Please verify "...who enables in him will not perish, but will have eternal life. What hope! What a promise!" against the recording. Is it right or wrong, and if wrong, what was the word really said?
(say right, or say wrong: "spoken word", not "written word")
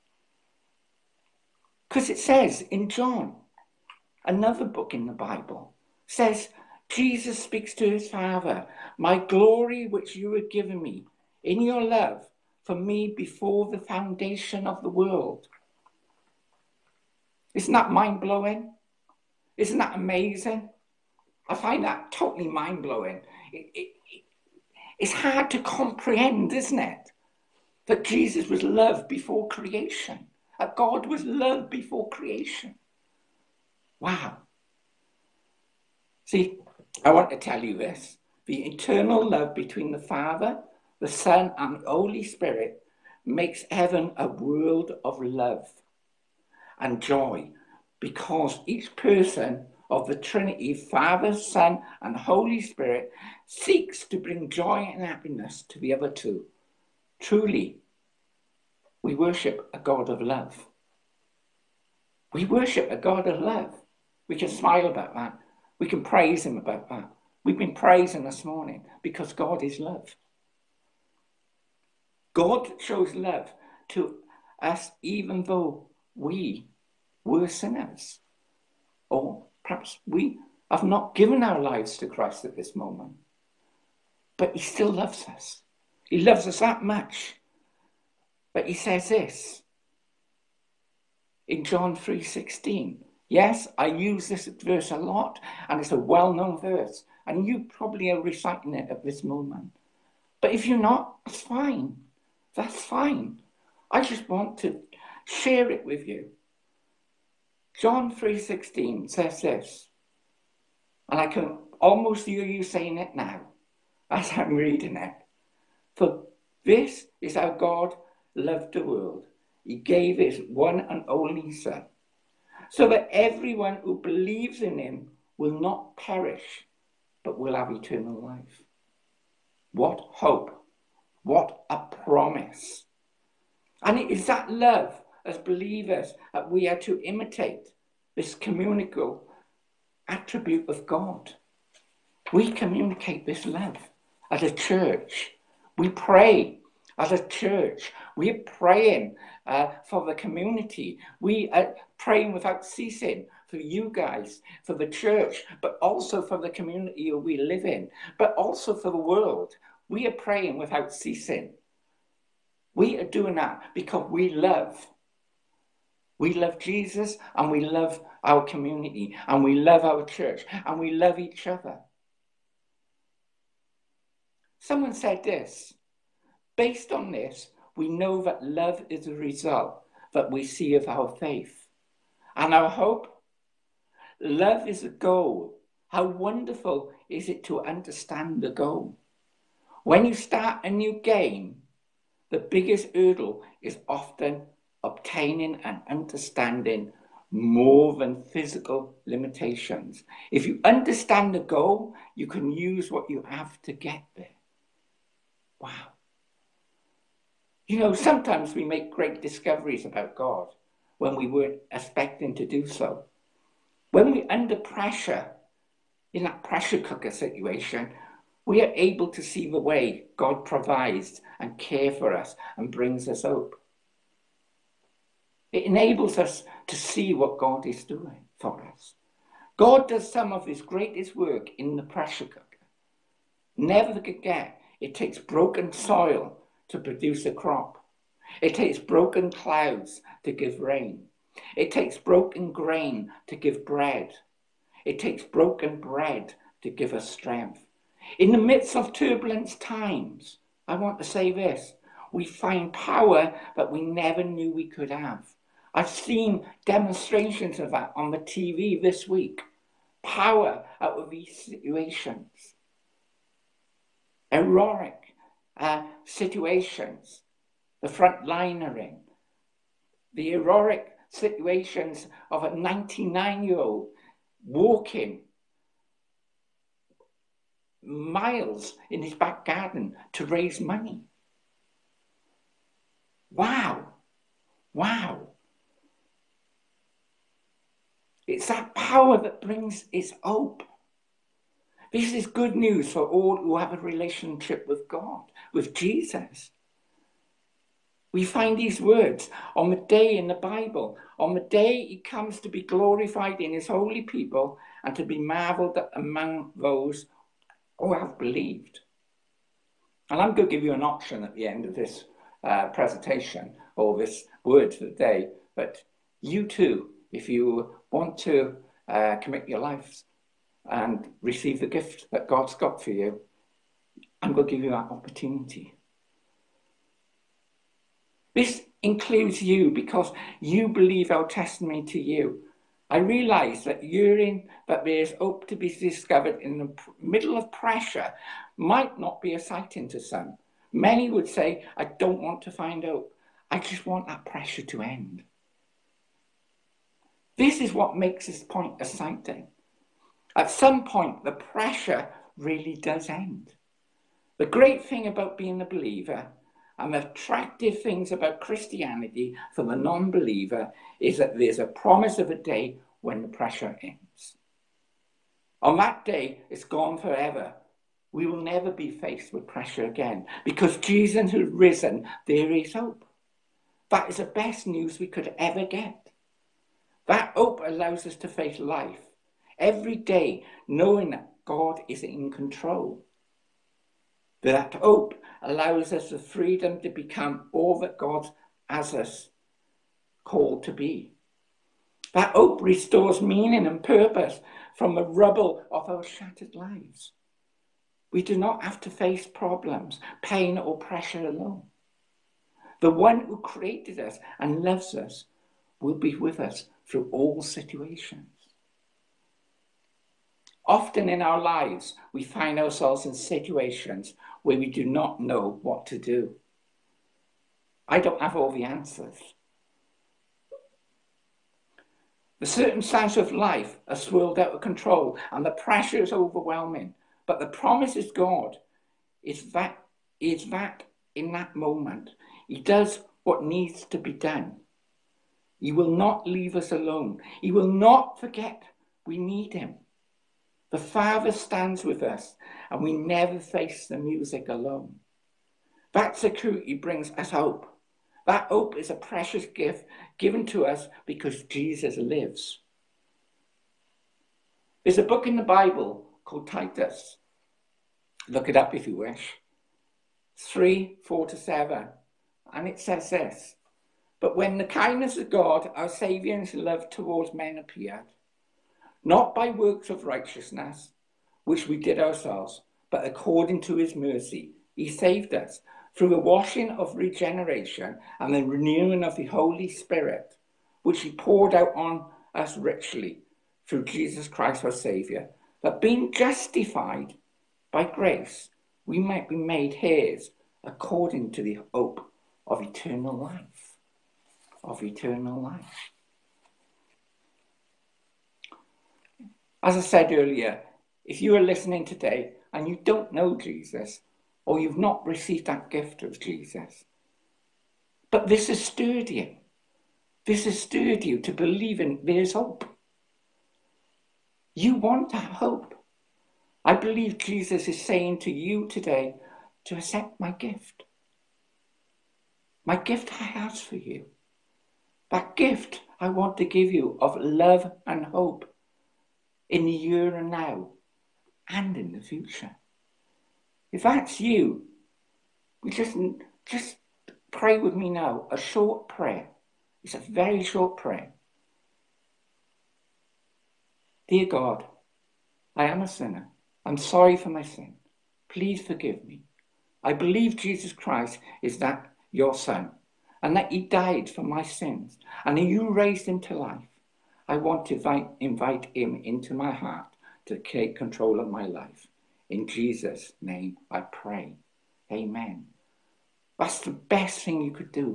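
wrong: "believes", not "enables".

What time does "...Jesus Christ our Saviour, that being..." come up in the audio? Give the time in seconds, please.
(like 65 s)
483 s.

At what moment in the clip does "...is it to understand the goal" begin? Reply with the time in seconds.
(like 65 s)
187 s.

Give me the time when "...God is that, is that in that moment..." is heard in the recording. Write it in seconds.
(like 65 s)
428 s.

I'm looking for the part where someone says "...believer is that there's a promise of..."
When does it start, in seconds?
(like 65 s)
360 s.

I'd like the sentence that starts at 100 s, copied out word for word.
But if you're not, that's fine.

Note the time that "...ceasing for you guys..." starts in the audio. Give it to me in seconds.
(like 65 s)
152 s.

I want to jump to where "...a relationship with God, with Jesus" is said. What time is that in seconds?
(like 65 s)
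293 s.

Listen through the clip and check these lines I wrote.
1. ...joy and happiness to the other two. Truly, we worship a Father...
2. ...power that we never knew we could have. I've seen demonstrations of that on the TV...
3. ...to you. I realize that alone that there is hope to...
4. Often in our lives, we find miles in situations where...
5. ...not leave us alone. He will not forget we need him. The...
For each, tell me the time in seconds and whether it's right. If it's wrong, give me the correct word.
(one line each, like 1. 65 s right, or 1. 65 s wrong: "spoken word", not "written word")
1. 54 s wrong: "God", not "Father"
2. 252 s right
3. 331 s wrong: "urine", not "alone"
4. 410 s wrong: "ourselves", not "miles"
5. 435 s right.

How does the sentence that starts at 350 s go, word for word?
At some point, the pressure really does end.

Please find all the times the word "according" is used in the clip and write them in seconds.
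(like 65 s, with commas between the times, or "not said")
473 s, 490 s.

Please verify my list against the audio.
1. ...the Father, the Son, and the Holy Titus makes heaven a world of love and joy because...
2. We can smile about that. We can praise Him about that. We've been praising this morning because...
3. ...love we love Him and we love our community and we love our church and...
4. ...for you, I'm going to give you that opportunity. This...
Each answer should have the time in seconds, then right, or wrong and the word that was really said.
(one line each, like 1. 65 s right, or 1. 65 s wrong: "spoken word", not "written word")
1. 39 s wrong: "Spirit", not "Titus"
2. 64 s right
3. 164 s wrong: "Jesus", not "Him"
4. 322 s right.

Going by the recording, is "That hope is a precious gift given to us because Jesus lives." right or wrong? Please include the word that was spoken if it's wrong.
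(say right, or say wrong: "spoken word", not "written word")
right.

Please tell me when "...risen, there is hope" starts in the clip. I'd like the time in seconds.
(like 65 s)
371 s.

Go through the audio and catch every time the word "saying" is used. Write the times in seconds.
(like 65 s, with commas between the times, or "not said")
112 s, 517 s.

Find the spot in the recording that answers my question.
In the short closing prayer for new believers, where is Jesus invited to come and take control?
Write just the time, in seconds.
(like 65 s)
559 s.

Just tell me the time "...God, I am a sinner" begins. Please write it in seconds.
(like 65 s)
544 s.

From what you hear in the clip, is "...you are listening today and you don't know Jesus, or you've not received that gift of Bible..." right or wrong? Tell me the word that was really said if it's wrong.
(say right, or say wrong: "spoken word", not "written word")
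wrong: "Jesus", not "Bible".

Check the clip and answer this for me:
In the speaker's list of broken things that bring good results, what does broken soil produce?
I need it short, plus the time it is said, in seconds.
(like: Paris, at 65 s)
a crop, at 237 s.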